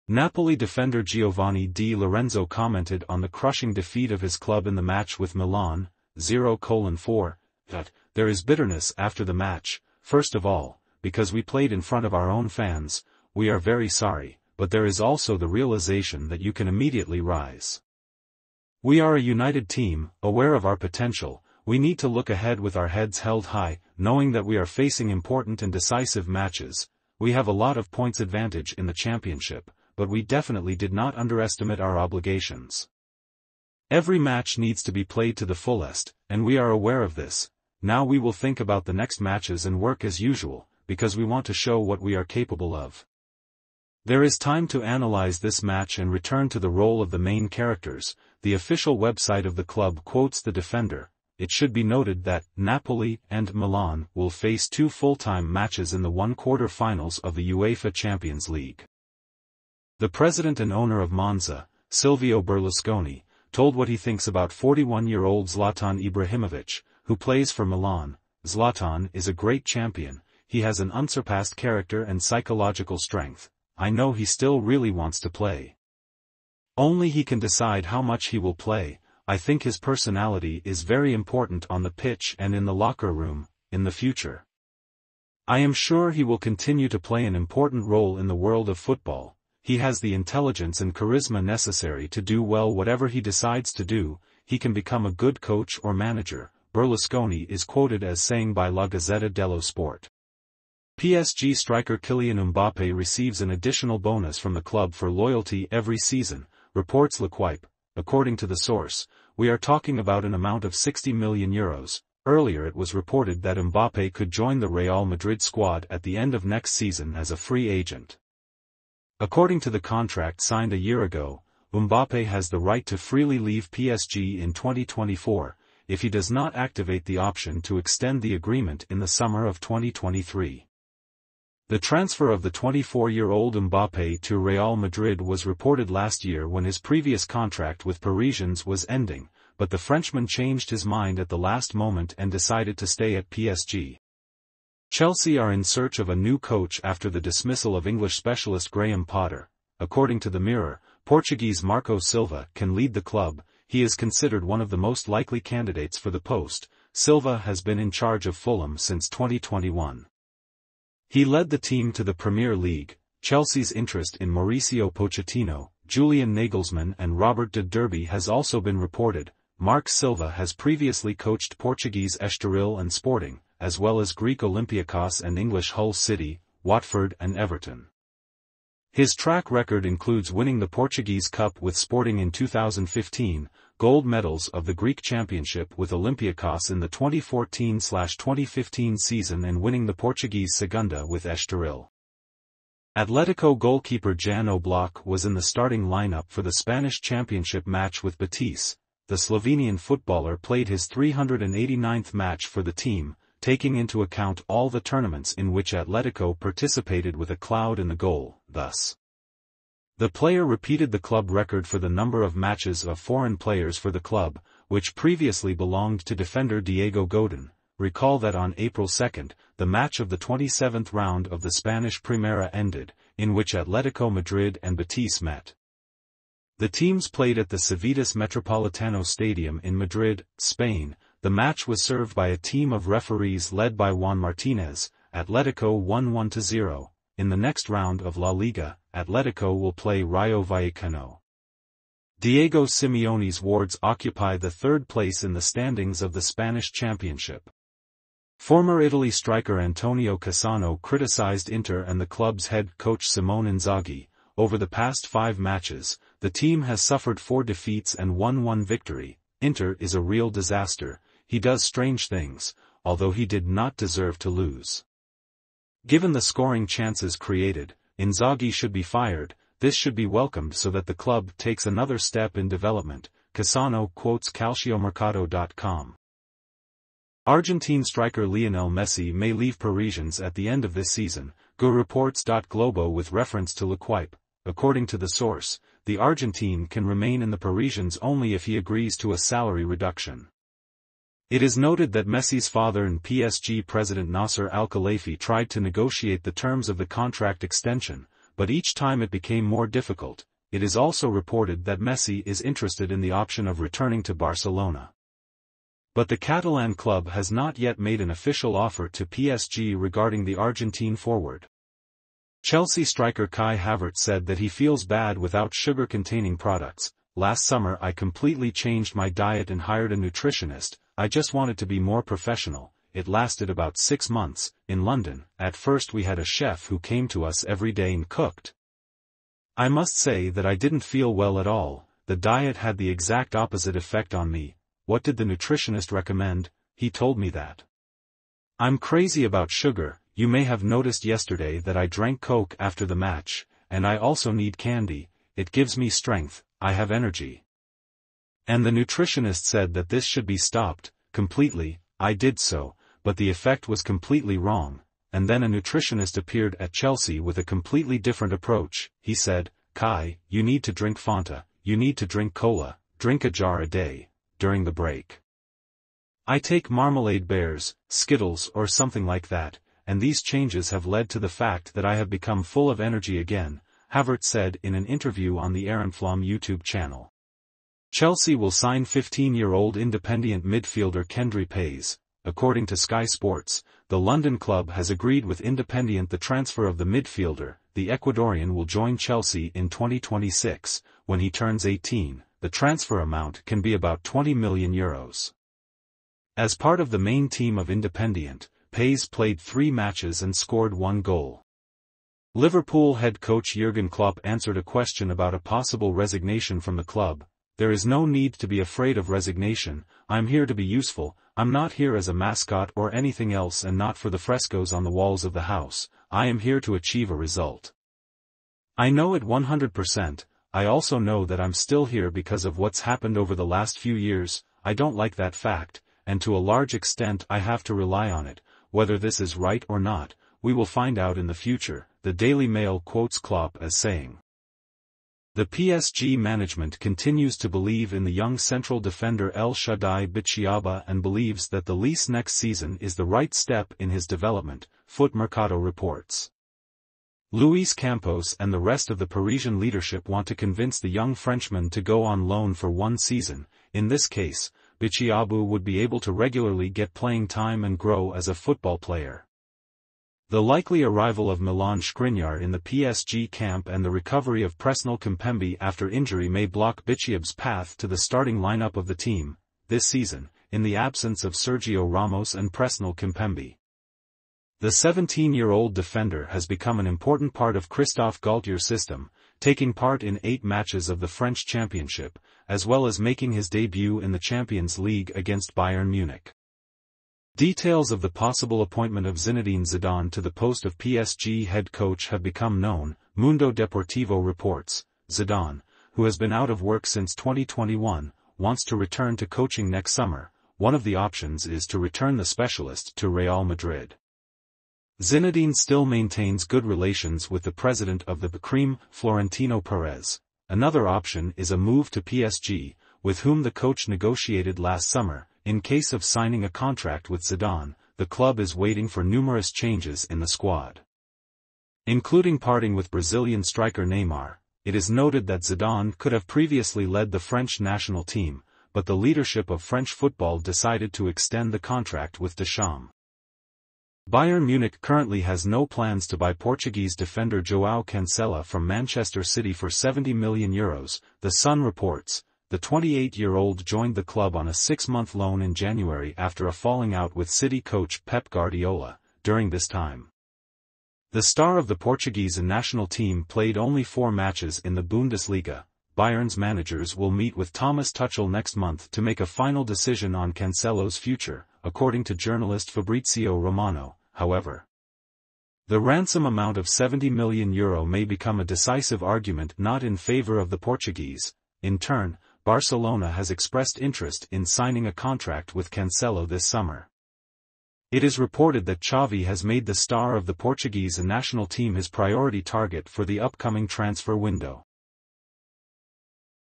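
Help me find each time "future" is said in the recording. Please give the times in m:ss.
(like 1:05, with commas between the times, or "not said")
1:23, 7:11, 9:20.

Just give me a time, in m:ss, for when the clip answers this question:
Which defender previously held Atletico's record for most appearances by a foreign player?
3:36.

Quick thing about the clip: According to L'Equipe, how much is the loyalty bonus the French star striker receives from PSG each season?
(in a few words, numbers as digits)
60 million euros.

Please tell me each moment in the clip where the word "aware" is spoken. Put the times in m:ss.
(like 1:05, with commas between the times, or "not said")
0:20, 0:36.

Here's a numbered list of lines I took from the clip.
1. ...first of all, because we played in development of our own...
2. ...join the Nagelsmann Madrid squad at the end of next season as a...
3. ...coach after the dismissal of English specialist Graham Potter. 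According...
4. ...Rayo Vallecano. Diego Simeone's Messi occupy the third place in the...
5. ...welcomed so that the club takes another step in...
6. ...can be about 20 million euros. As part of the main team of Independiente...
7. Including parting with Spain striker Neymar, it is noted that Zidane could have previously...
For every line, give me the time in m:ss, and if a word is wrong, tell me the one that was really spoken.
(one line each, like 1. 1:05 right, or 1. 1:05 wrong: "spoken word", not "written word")
1. 0:10 wrong: "front", not "development"
2. 1:54 wrong: "Real", not "Nagelsmann"
3. 2:26 right
4. 4:00 wrong: "Wards", not "Messi"
5. 4:30 right
6. 6:33 right
7. 8:41 wrong: "Brazilian", not "Spain".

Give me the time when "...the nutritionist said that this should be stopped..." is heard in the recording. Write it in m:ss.
5:48.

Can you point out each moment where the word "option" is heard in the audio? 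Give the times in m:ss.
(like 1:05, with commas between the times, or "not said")
2:07, 5:03, 8:20, 8:30.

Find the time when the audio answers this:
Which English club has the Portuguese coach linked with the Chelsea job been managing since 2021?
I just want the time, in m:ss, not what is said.
2:38.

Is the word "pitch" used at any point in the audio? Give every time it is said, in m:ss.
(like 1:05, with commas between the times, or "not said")
1:21.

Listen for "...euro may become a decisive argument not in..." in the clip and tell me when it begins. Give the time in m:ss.
9:27.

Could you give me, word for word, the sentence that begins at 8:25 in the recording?
Zinedine still maintains good relations with the president of the Bacrim, Florentino Perez.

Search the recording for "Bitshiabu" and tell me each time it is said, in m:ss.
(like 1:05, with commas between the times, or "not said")
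7:20, 7:34.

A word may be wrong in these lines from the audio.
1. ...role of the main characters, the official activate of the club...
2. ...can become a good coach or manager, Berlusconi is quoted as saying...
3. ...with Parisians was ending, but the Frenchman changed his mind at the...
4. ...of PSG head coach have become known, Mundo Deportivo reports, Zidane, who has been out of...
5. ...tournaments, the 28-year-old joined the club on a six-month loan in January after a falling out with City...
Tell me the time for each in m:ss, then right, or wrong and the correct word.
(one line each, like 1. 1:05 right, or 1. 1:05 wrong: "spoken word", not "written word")
1. 0:46 wrong: "website", not "activate"
2. 1:34 right
3. 2:17 right
4. 8:10 right
5. 9:01 wrong: "reports", not "tournaments".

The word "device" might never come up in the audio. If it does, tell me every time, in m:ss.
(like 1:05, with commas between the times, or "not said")
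not said.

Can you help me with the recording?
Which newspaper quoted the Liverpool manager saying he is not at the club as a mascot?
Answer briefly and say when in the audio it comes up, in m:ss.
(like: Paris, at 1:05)
Daily Mail, at 7:12.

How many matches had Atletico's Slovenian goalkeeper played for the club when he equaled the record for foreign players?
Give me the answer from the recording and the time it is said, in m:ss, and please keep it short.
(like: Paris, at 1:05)
389, at 3:20.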